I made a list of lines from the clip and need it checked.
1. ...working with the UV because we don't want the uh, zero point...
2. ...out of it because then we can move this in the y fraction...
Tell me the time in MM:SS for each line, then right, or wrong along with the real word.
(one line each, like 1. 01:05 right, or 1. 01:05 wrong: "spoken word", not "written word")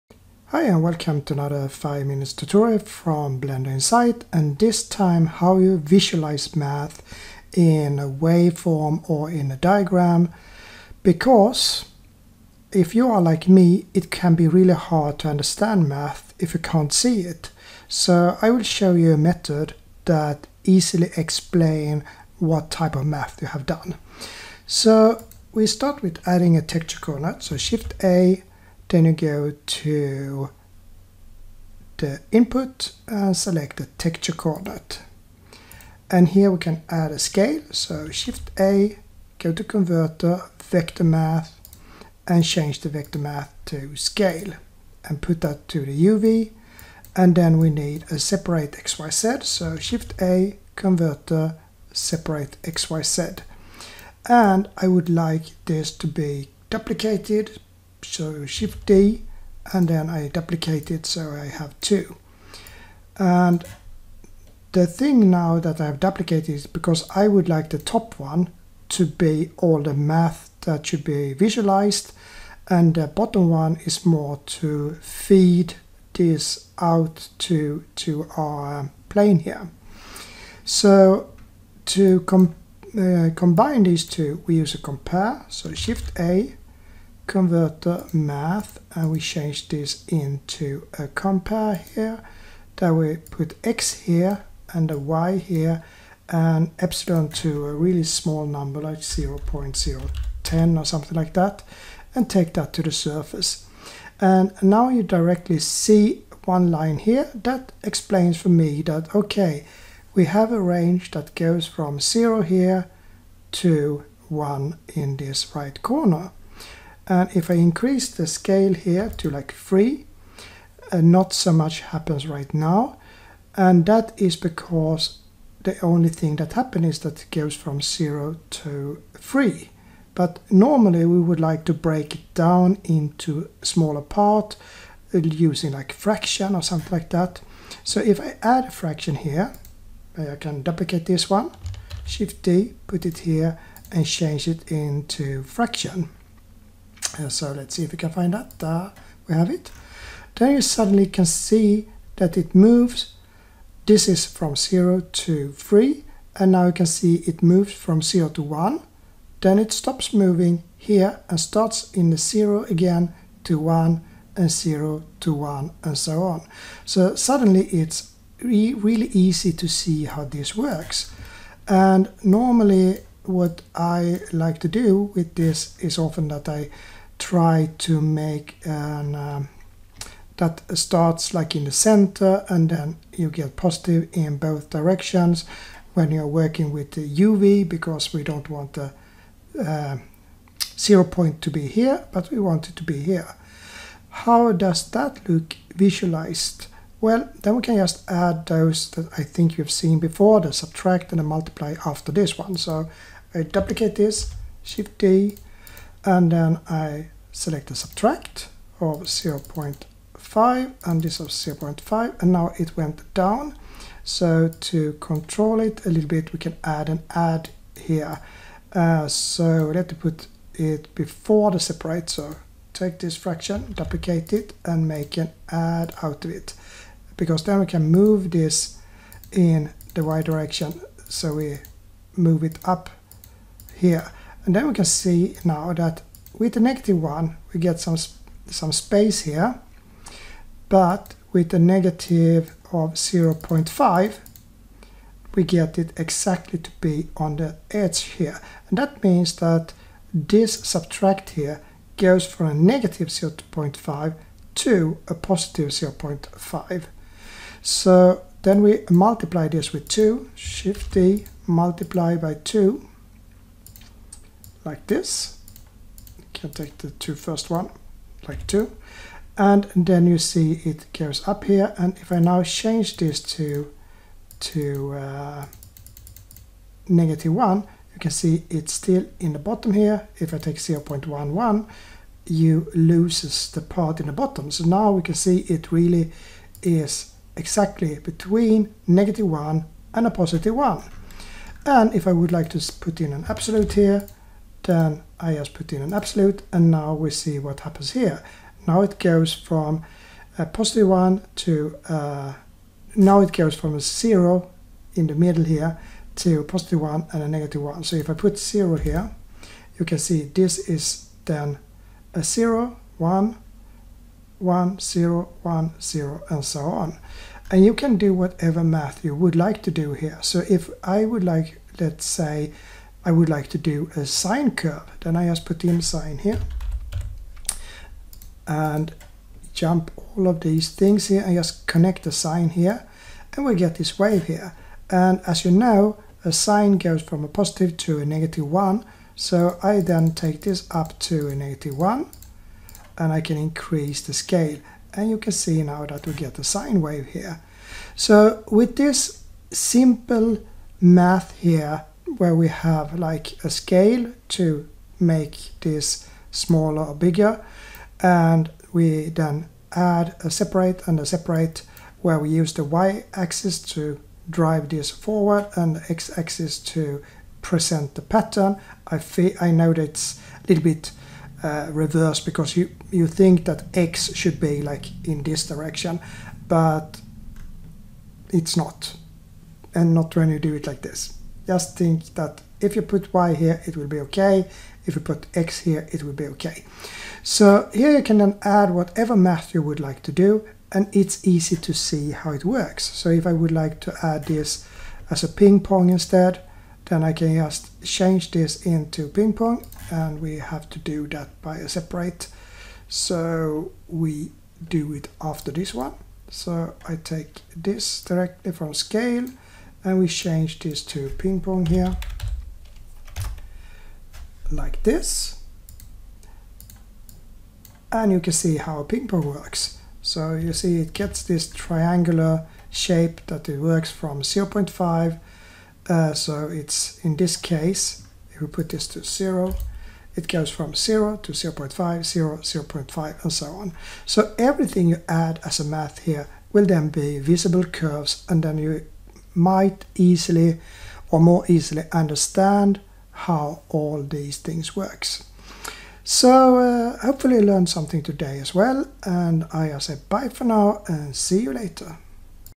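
1. 03:06 right
2. 03:46 wrong: "direction", not "fraction".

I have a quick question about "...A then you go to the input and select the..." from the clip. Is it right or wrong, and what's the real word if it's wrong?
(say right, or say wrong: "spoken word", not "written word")
right.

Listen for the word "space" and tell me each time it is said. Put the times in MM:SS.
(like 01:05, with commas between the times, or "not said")
03:58.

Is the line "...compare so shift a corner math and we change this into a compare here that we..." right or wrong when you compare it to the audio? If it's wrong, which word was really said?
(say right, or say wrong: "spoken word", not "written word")
wrong: "converter", not "corner".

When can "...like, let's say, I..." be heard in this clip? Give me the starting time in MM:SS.
05:21.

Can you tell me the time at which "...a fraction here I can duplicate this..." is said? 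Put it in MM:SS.
02:18.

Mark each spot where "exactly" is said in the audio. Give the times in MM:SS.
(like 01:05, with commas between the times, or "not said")
04:05, 04:47.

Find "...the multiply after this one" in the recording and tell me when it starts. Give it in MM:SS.
03:21.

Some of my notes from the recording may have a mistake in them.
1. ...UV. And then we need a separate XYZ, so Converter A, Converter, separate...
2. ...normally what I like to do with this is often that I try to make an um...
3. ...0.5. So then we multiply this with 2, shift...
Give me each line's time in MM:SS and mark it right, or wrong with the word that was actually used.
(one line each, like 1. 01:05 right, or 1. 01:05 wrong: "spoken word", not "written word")
1. 00:46 wrong: "Shift", not "Converter"
2. 02:52 right
3. 04:15 right.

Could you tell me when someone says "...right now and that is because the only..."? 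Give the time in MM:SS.
02:02.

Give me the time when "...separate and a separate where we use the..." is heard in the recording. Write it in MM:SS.
06:00.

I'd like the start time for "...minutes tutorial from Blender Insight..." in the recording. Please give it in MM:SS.
00:02.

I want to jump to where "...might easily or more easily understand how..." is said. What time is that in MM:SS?
07:19.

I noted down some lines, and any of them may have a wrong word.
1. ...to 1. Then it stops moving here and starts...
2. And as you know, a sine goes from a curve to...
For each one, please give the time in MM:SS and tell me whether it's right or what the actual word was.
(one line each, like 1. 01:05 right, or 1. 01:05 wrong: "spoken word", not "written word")
1. 02:38 right
2. 05:34 wrong: "positive", not "curve".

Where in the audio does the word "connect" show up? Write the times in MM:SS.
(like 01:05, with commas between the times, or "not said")
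05:31.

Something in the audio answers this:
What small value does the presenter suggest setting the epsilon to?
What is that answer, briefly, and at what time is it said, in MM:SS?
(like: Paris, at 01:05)
0.010, at 01:38.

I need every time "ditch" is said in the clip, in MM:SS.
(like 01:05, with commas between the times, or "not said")
not said.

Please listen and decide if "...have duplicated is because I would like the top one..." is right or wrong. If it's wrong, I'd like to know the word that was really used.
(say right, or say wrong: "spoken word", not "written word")
right.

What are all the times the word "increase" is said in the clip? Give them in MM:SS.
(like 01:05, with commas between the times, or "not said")
01:57, 05:43.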